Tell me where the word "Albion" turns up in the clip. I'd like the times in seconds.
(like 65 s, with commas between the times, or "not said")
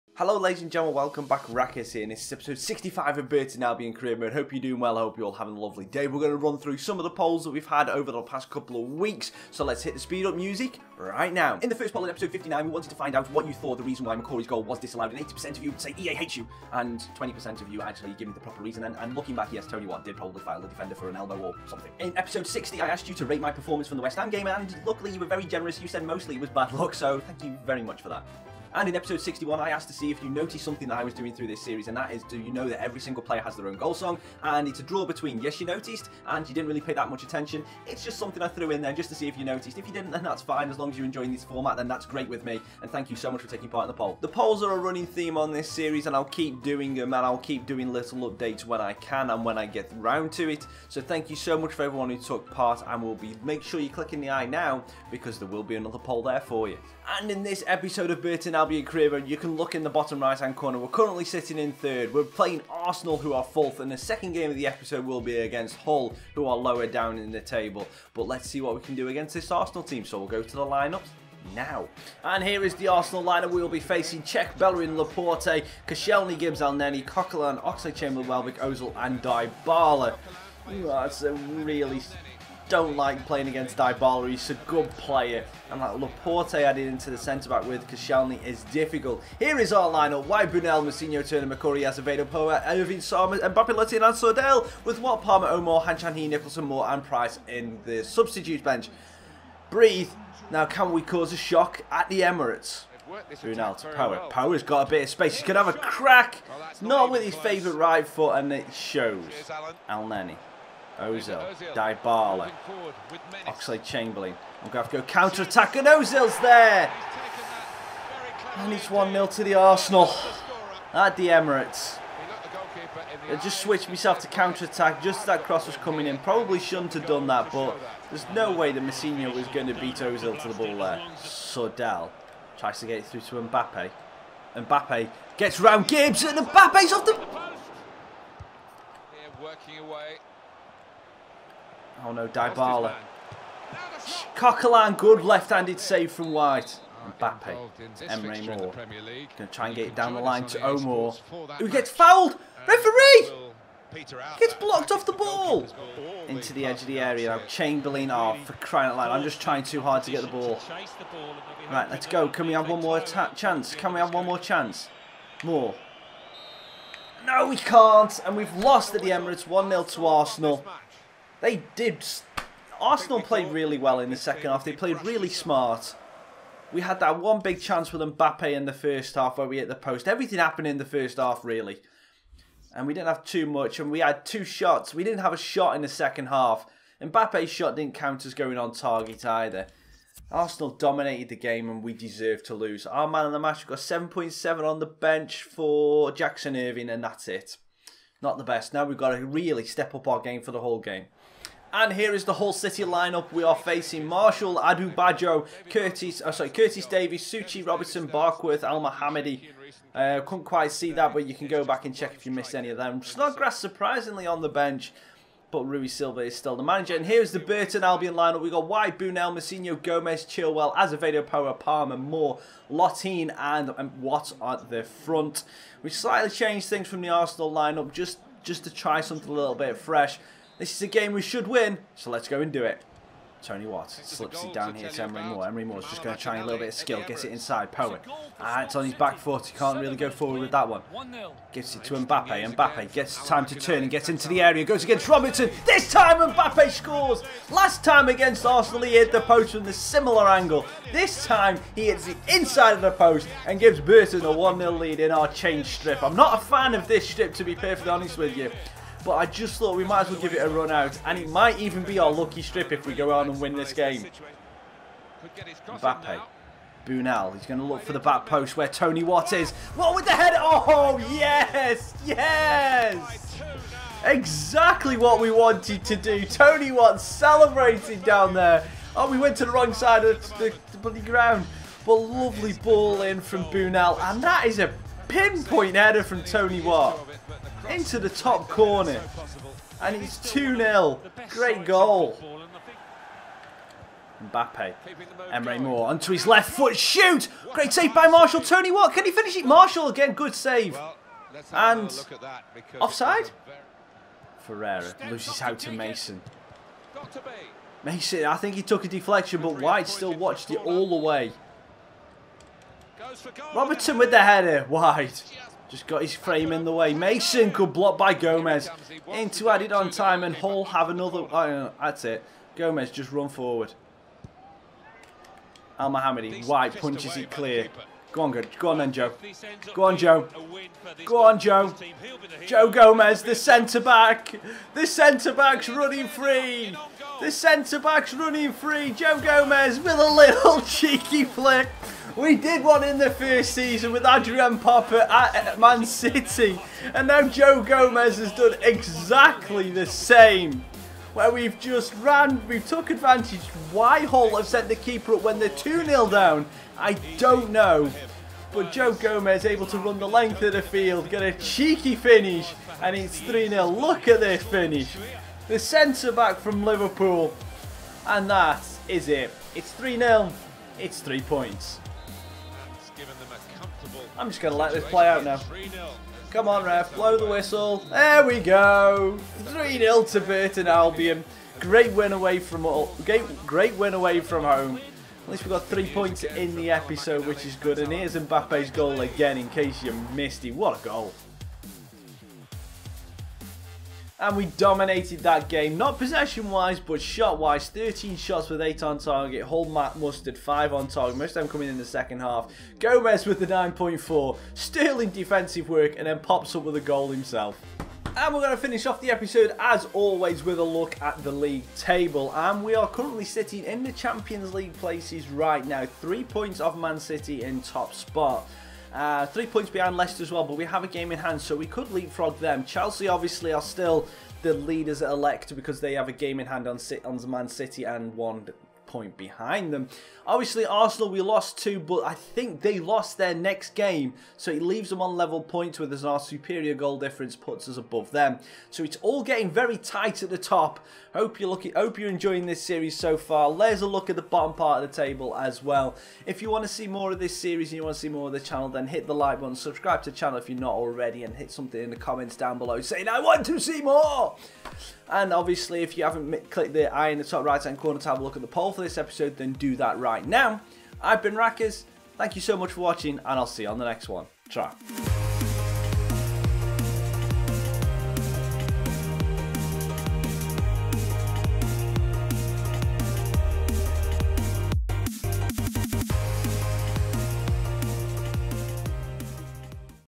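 3 s, 58 s, 217 s, 380 s.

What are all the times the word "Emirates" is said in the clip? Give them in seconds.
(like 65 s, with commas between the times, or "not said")
102 s, 121 s, 169 s.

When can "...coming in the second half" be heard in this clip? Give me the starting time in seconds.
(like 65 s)
401 s.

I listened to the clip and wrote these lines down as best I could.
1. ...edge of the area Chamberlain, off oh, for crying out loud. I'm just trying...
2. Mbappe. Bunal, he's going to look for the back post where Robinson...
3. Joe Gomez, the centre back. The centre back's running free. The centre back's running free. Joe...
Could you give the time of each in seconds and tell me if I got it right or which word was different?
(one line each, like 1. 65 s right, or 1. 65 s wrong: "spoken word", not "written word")
1. 156 s right
2. 265 s wrong: "Tony", not "Robinson"
3. 332 s right.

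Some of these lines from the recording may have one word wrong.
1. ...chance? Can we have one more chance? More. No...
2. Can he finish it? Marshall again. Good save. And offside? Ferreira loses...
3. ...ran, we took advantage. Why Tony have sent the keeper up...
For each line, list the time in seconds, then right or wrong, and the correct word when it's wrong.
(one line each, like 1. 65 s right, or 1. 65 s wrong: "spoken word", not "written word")
1. 162 s right
2. 298 s right
3. 352 s wrong: "Hull", not "Tony".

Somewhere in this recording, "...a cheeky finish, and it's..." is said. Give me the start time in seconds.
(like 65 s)
361 s.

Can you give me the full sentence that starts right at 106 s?
Well, not, not with his favourite right foot, and it shows.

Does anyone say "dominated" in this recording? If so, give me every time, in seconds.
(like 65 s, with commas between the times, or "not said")
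190 s, 394 s.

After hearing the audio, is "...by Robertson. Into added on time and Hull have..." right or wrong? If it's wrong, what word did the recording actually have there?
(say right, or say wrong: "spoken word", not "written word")
wrong: "Gomez", not "Robertson".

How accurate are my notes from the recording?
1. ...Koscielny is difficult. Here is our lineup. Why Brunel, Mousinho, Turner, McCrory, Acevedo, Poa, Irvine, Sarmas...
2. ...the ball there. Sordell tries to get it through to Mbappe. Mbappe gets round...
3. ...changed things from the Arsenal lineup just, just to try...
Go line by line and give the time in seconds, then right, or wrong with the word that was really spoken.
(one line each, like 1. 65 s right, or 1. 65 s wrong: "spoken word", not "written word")
1. 87 s right
2. 130 s right
3. 226 s right.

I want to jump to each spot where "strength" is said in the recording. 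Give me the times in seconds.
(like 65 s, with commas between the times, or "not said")
not said.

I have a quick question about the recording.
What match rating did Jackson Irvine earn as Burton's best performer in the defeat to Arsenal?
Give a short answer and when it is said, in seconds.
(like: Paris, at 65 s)
7.7, at 193 s.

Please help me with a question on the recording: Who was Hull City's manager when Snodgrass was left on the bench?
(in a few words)
Rui Silva.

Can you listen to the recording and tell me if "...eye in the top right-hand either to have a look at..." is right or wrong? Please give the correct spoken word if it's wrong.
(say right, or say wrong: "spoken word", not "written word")
wrong: "corner", not "either".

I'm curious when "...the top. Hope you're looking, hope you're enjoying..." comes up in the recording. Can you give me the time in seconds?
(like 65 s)
440 s.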